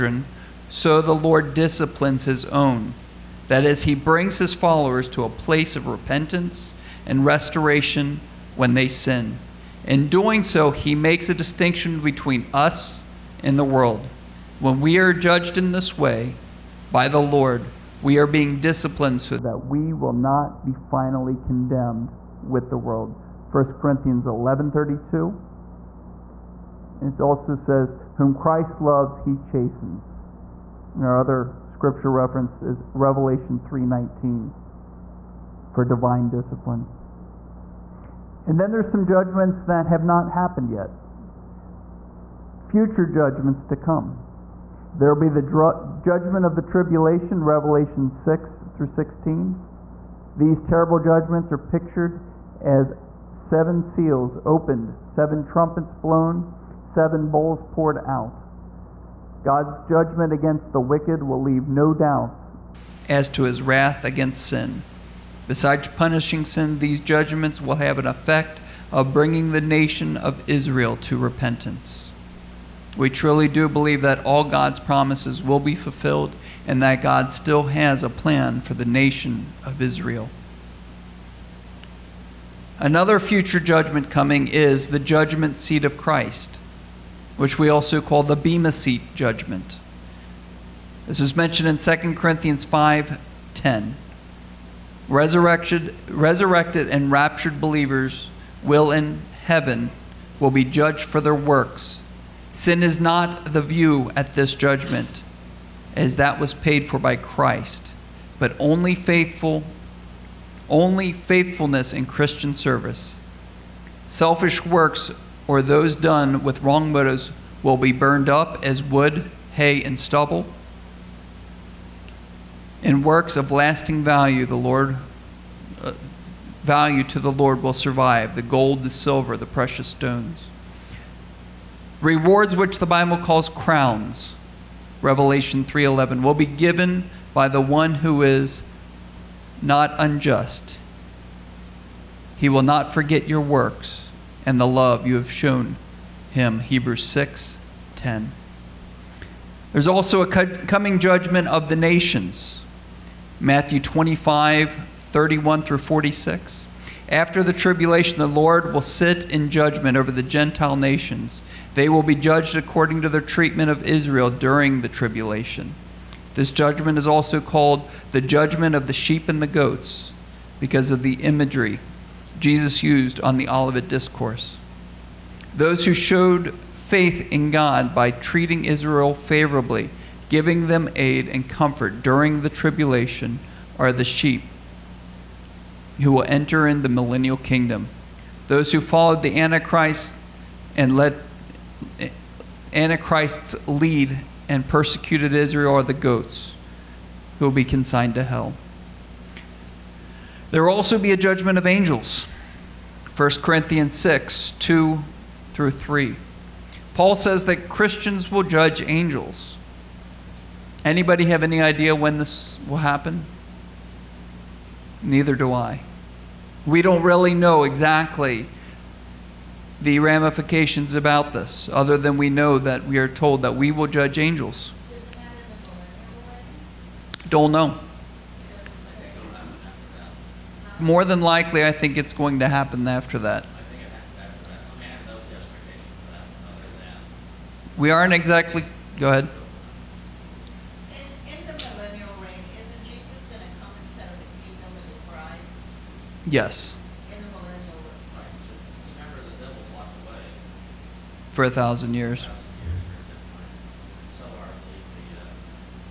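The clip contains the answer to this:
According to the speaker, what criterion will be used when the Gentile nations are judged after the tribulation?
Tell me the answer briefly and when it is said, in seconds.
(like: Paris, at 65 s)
Their treatment of Israel, at 163 s.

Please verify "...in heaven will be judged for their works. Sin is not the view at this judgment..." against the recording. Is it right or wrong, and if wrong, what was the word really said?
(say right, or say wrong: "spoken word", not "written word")
right.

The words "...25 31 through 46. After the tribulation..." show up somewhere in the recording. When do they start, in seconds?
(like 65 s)
153 s.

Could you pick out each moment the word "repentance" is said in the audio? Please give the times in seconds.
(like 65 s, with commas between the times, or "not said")
5 s, 71 s.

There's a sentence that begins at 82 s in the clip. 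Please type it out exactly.
Another future judgment coming is the judgment seat of Christ, which we also call the Bema seat judgment.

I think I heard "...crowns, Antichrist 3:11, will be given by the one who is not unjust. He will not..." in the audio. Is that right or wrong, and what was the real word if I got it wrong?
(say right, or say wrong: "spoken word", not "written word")
wrong: "Revelation", not "Antichrist".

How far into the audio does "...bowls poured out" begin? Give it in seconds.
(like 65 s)
57 s.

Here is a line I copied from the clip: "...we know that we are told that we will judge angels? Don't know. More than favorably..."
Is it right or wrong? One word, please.
wrong.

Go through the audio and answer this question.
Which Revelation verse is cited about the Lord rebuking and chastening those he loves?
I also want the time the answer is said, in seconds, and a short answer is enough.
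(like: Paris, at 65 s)
Revelation 3:19, at 32 s.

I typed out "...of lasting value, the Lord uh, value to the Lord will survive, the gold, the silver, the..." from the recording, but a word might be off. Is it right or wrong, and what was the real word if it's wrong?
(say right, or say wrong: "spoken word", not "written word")
right.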